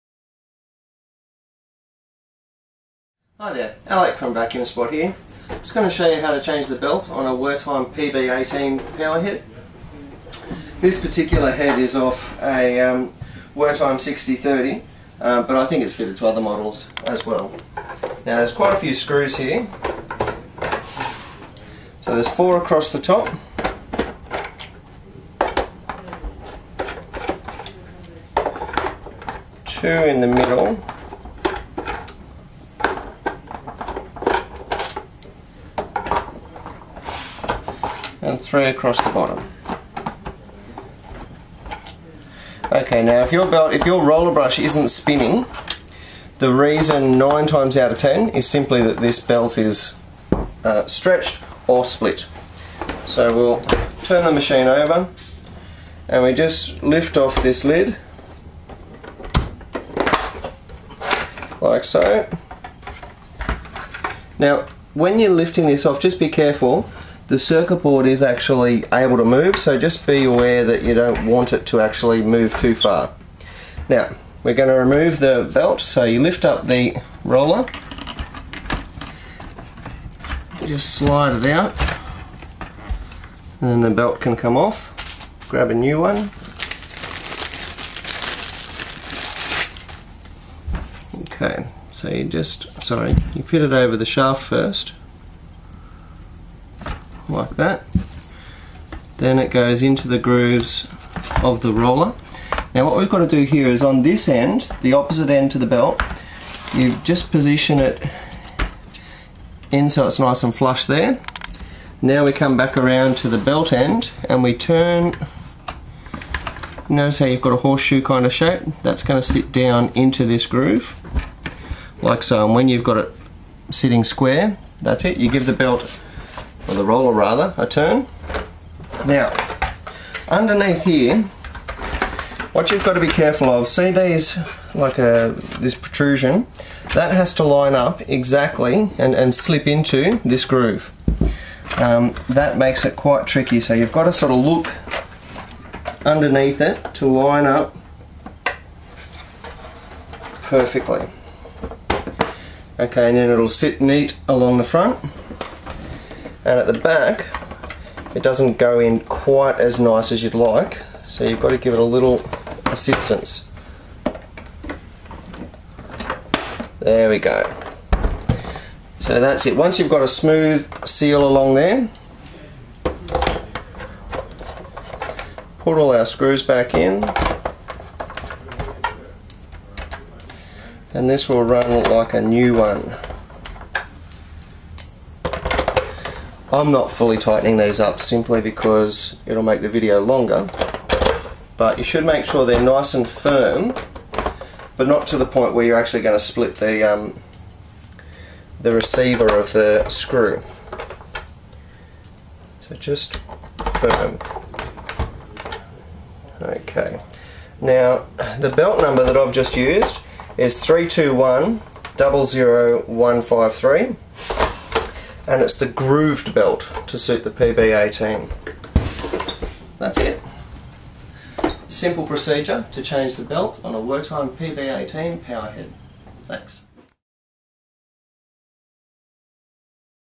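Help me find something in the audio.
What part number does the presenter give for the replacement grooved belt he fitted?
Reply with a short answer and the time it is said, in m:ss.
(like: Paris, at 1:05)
321 00153, at 3:30.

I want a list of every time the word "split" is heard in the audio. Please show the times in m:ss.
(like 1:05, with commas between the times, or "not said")
0:51, 3:16.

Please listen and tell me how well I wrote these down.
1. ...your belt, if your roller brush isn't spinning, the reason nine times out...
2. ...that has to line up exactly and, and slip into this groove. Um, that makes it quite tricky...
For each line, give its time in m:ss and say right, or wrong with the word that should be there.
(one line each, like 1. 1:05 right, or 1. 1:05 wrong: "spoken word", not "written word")
1. 0:43 right
2. 2:16 right.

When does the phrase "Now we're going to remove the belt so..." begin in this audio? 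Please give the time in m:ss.
1:13.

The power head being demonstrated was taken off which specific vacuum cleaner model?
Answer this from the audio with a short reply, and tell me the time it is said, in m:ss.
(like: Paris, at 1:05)
Wertheim 6030, at 0:13.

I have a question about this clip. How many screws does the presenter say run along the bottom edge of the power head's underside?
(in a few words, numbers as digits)
3.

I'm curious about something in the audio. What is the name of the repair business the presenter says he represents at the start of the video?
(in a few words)
Vacuum Spot.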